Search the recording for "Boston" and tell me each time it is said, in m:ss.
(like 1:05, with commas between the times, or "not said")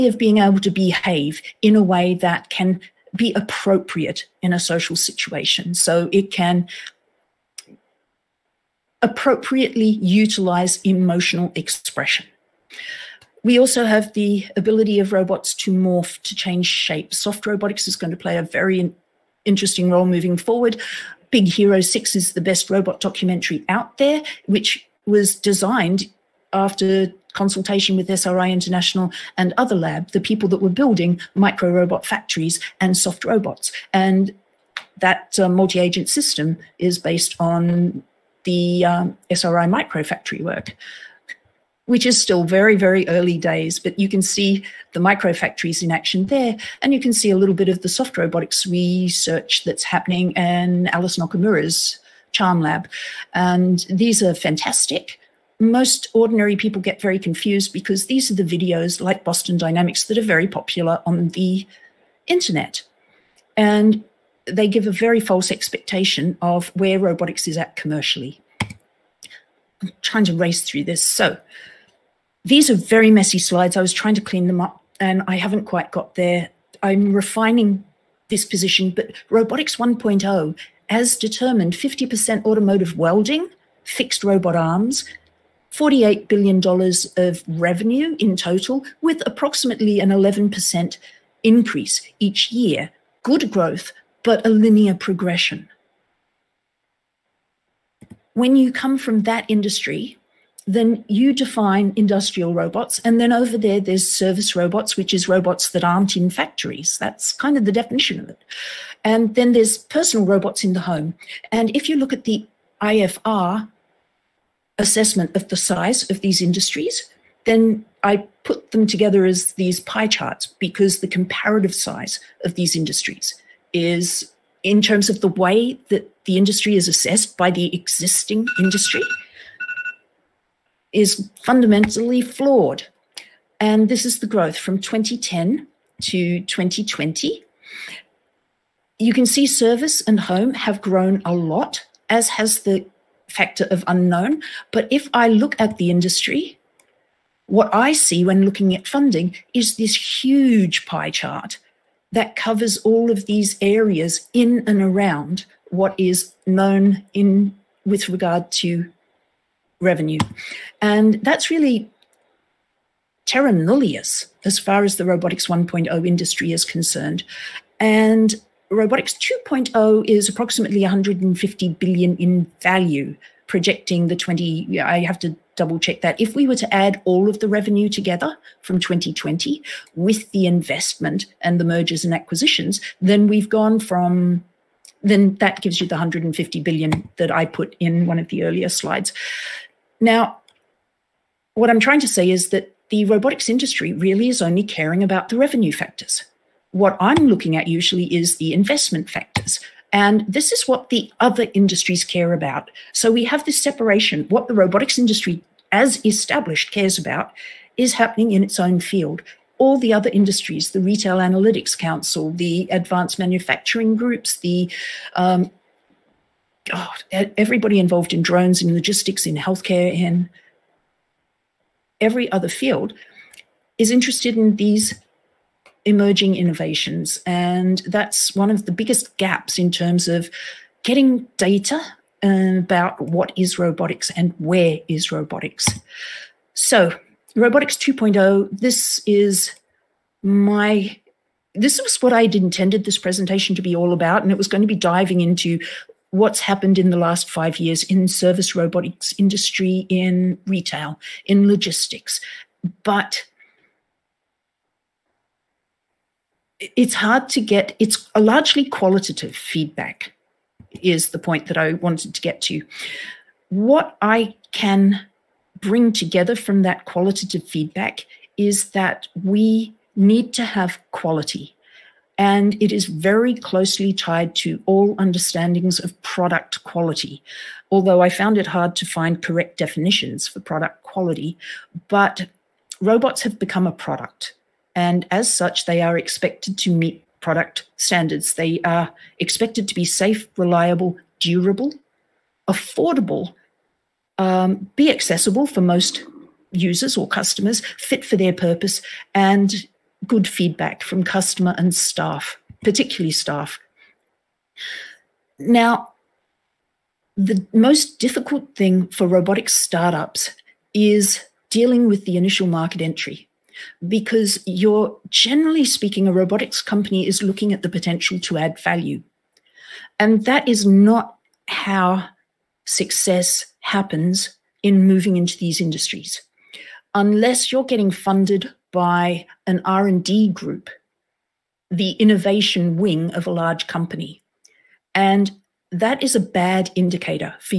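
0:59.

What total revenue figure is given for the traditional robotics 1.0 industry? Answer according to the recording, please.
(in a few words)
$48 billion.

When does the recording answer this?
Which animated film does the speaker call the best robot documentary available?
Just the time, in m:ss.
0:21.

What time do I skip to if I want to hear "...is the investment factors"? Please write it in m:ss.
3:18.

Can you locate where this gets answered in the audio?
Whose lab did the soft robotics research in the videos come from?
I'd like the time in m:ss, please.
0:50.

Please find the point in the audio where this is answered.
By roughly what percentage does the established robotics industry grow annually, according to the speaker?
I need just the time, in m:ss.
1:30.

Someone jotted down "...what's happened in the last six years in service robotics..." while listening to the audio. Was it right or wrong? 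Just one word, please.
wrong.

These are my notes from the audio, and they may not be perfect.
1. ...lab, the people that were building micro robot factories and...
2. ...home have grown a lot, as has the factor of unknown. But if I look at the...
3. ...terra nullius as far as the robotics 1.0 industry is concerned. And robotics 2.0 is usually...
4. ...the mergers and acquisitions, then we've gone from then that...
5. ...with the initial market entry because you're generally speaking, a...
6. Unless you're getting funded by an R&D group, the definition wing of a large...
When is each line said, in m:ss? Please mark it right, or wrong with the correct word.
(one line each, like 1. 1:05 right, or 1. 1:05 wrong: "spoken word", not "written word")
1. 0:29 right
2. 2:20 right
3. 2:43 wrong: "approximately", not "usually"
4. 3:01 right
5. 5:11 right
6. 5:26 wrong: "innovation", not "definition".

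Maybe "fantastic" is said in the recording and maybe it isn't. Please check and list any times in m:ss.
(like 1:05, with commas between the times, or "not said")
0:54.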